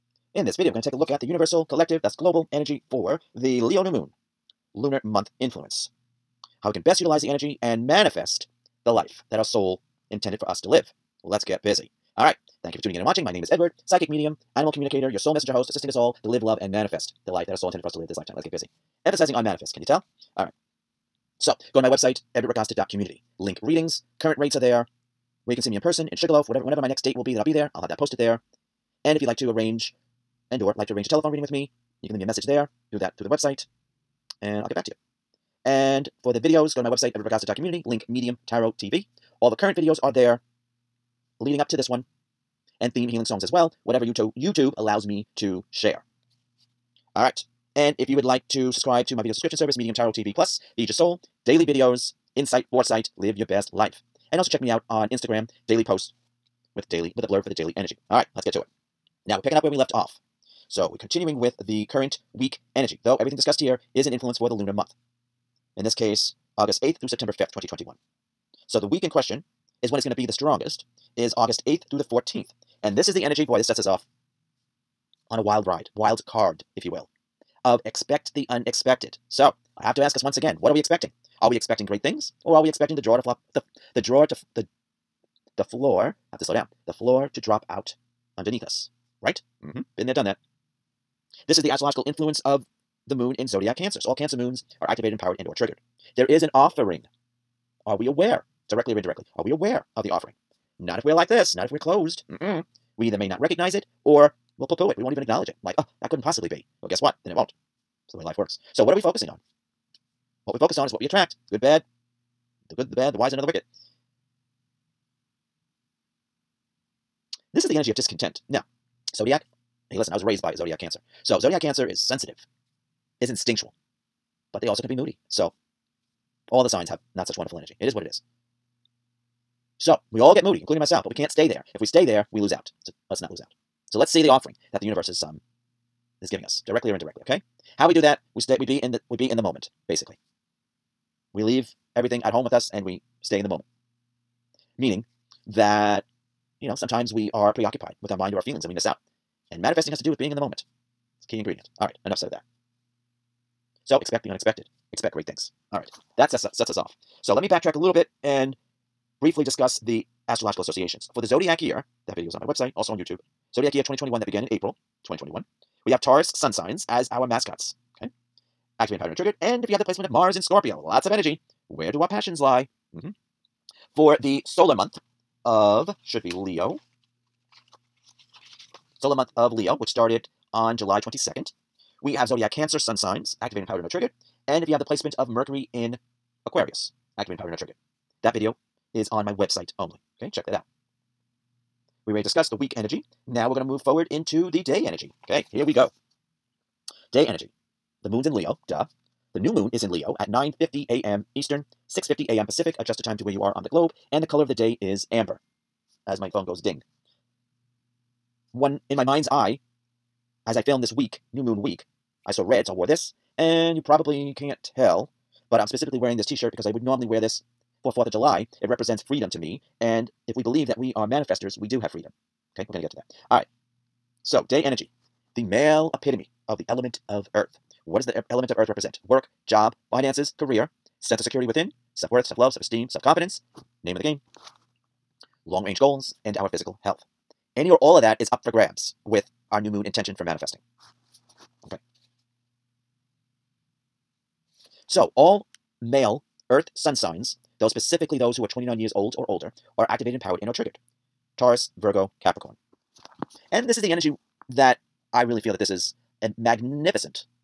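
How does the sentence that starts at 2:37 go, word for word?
So let me backtrack a little bit and briefly discuss the astrological associations.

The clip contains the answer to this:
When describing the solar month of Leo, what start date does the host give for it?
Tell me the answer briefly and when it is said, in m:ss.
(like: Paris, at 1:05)
July 22nd, at 3:00.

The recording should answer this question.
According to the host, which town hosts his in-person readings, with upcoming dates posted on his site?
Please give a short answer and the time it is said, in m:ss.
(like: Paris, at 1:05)
Sugarloaf, at 0:26.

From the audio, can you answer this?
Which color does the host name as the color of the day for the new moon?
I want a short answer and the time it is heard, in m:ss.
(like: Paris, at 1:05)
amber, at 3:25.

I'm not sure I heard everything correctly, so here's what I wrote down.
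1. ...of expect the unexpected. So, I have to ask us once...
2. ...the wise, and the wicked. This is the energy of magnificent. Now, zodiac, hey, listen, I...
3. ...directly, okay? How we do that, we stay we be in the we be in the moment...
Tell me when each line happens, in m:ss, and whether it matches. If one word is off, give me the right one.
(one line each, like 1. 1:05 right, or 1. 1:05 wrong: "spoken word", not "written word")
1. 1:17 right
2. 1:53 wrong: "discontent", not "magnificent"
3. 2:16 wrong: "indirectly", not "directly".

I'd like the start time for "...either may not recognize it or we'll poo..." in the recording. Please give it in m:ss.
1:43.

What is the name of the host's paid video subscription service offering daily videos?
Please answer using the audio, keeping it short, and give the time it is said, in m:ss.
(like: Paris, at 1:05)
Medium Tarot TV Plus, at 0:49.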